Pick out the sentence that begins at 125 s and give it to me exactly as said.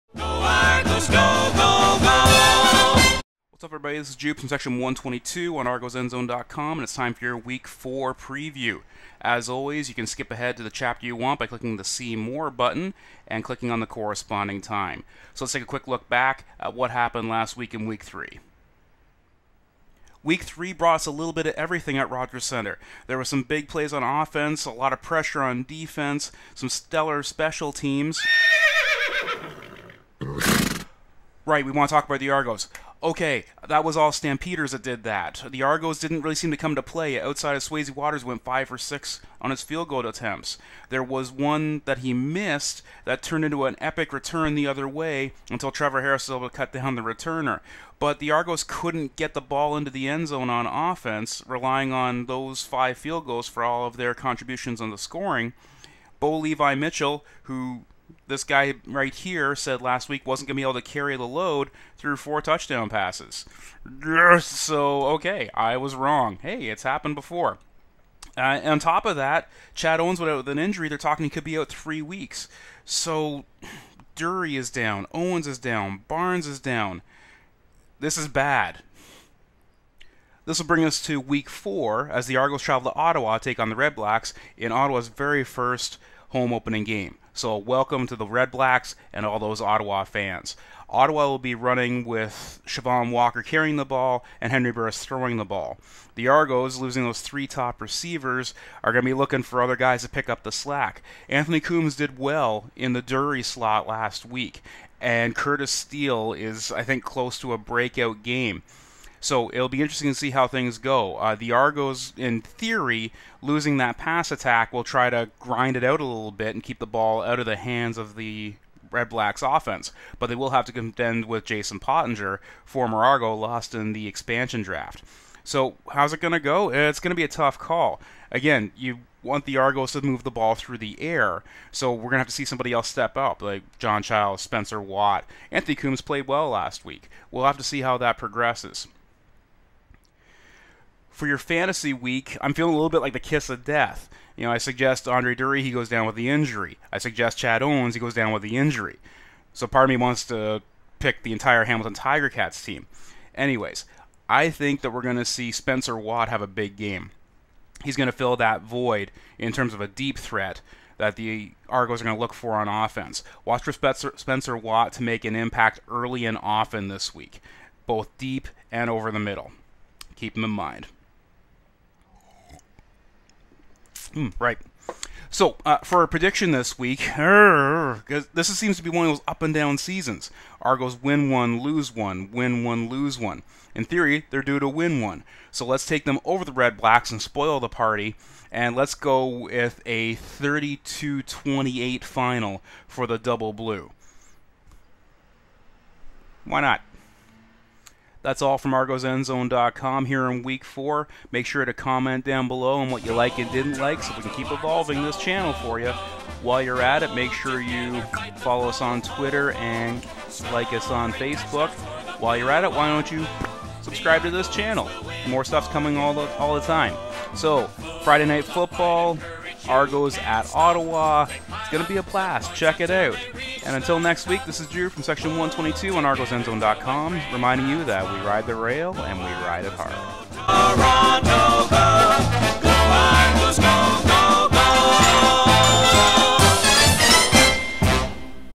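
So how's it going to go?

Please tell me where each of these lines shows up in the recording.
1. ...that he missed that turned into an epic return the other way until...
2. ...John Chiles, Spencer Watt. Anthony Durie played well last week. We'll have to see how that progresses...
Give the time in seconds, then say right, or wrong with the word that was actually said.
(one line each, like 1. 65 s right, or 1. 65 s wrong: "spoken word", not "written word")
1. 41 s right
2. 133 s wrong: "Coombs", not "Durie".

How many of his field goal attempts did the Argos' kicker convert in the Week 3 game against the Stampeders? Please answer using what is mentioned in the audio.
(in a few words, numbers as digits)
5 for 6.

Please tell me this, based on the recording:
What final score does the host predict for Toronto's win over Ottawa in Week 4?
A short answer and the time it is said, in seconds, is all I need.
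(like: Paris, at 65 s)
32-28, at 190 s.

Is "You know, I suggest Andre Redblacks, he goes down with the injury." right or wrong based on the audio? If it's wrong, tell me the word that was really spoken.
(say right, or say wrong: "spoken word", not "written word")
wrong: "Durie", not "Redblacks".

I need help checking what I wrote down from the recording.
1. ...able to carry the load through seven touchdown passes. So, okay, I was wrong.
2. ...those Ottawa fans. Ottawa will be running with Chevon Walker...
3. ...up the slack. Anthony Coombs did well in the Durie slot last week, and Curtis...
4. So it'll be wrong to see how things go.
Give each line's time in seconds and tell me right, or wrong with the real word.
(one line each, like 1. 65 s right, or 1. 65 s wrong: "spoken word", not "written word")
1. 60 s wrong: "four", not "seven"
2. 89 s right
3. 100 s right
4. 109 s wrong: "interesting", not "wrong".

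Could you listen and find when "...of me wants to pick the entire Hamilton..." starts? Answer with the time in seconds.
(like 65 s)
149 s.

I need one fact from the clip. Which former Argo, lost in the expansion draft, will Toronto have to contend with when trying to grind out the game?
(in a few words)
Jason Pottinger.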